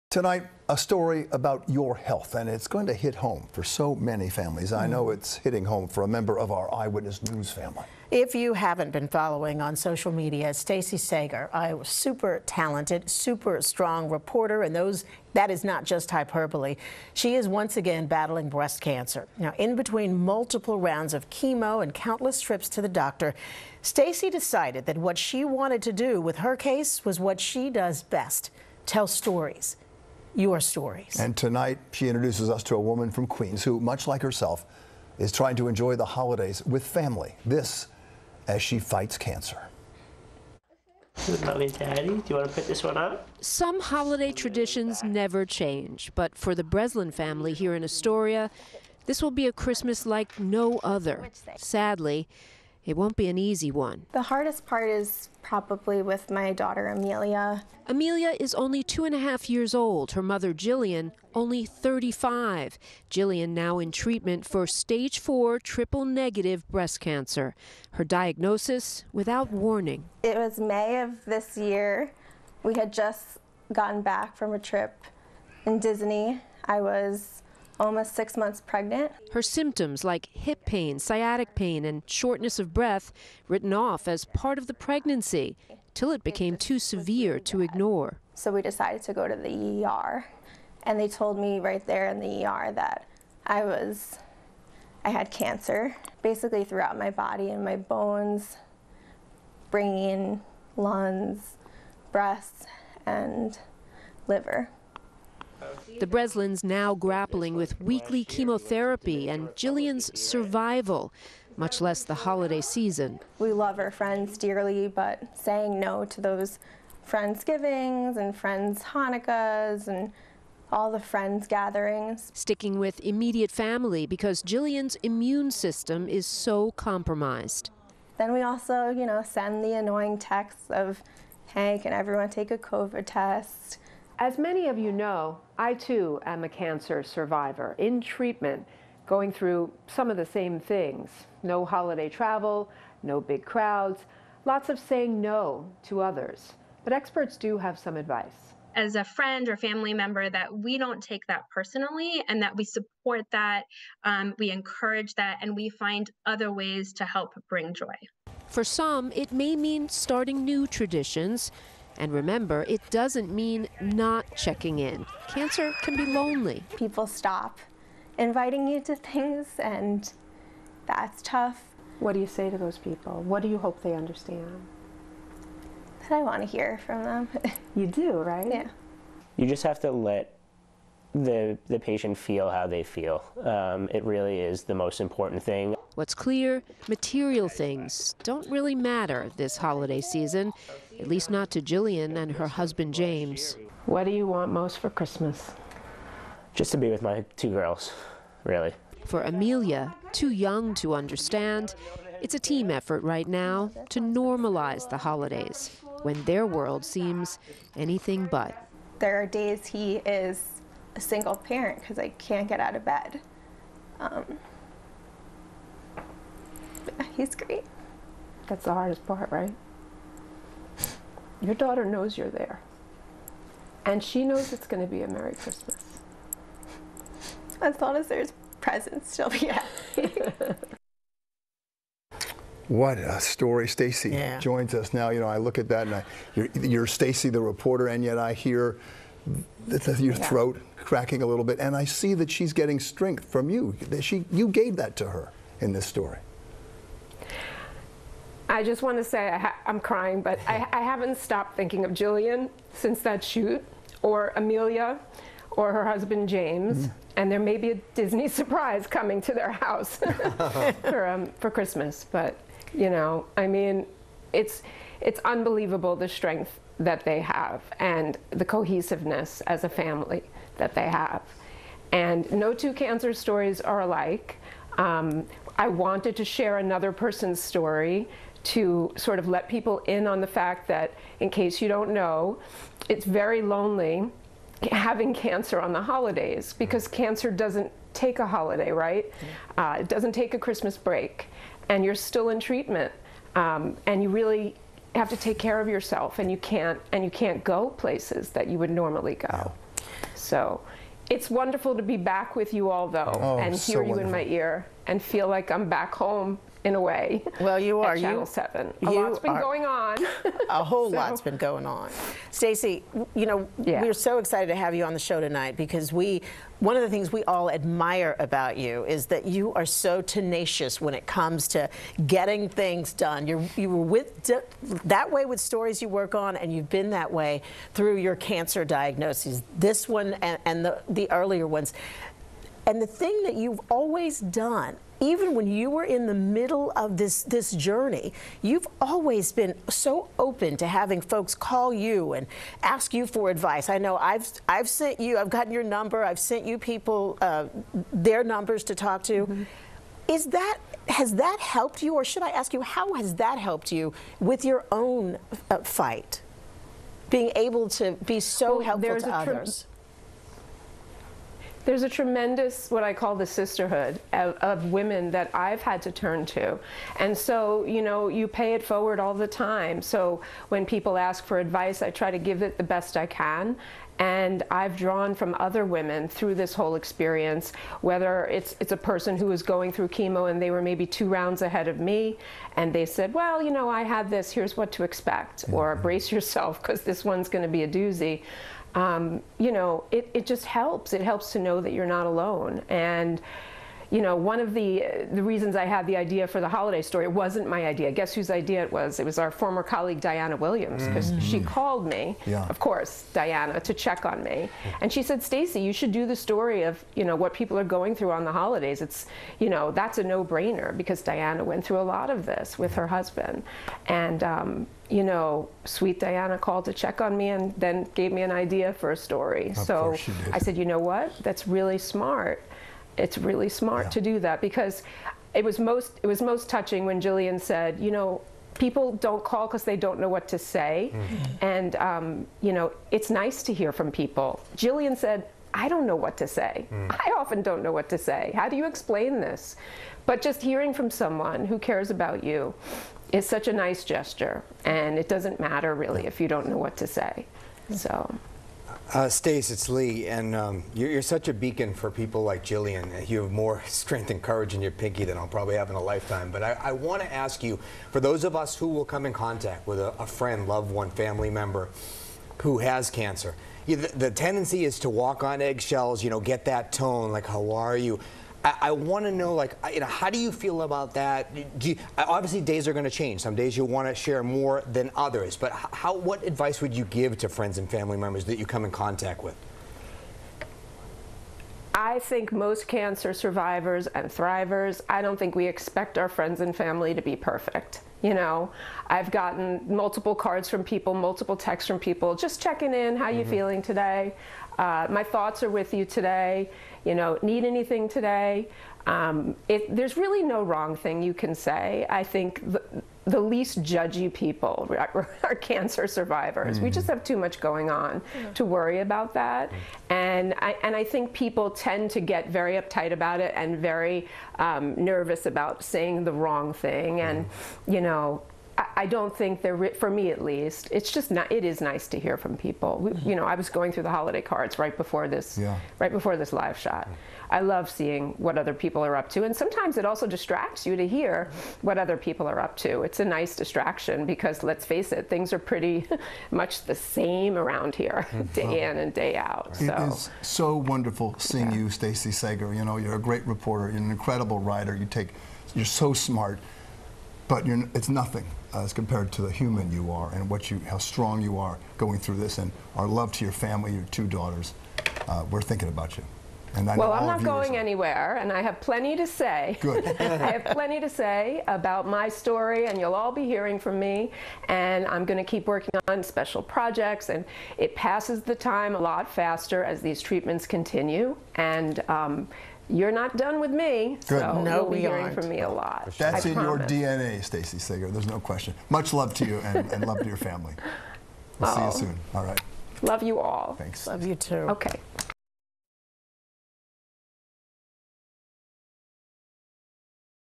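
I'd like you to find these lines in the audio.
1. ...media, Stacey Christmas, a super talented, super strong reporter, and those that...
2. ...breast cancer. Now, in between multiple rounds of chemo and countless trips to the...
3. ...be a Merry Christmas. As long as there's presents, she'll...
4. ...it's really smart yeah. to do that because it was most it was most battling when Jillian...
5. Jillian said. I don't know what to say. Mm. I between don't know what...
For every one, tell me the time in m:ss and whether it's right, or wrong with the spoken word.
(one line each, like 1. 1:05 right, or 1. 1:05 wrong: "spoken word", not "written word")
1. 0:10 wrong: "Sager", not "Christmas"
2. 0:18 right
3. 3:44 right
4. 7:02 wrong: "touching", not "battling"
5. 7:14 wrong: "often", not "between".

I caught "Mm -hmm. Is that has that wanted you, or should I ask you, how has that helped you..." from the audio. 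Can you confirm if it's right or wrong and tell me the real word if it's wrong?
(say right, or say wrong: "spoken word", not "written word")
wrong: "helped", not "wanted".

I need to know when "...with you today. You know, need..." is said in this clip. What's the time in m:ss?
8:15.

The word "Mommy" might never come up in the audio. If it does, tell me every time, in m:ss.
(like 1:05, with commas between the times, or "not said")
0:41.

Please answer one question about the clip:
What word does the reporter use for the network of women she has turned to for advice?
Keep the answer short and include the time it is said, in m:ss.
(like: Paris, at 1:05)
sisterhood, at 6:03.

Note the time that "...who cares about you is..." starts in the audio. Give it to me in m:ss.
7:21.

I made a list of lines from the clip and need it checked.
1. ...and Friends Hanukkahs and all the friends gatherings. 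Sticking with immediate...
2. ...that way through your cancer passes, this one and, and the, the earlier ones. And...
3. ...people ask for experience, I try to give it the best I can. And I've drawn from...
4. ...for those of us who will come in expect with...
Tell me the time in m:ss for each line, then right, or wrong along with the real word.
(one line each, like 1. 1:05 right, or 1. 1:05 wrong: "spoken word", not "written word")
1. 1:58 right
2. 5:26 wrong: "diagnoses", not "passes"
3. 6:10 wrong: "advice", not "experience"
4. 7:37 wrong: "contact", not "expect".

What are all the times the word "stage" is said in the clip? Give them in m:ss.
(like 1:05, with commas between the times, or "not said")
1:04.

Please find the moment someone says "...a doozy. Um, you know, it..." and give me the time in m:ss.
6:27.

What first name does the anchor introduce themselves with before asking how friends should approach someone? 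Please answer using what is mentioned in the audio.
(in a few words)
Lee.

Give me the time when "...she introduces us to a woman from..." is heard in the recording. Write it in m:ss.
0:31.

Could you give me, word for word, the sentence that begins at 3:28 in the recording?
There are days he is a single parent because I can't get out of bed.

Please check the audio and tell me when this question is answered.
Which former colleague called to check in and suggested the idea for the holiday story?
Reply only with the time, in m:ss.
6:40.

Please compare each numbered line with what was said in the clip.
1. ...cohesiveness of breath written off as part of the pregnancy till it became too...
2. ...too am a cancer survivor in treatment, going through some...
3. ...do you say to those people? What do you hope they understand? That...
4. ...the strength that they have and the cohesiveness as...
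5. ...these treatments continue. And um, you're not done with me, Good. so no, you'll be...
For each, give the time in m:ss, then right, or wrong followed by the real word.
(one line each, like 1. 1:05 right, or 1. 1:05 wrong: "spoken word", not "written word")
1. 1:22 wrong: "shortness", not "cohesiveness"
2. 2:15 right
3. 2:52 right
4. 4:25 right
5. 9:29 right.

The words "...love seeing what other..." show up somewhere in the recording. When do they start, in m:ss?
8:47.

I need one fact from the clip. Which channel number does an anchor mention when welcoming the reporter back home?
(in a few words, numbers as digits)
7.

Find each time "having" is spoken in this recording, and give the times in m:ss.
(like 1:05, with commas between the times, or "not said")
4:44, 5:40.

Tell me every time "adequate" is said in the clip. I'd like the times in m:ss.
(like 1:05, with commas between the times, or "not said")
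not said.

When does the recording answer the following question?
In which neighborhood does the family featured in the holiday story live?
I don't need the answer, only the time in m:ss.
0:47.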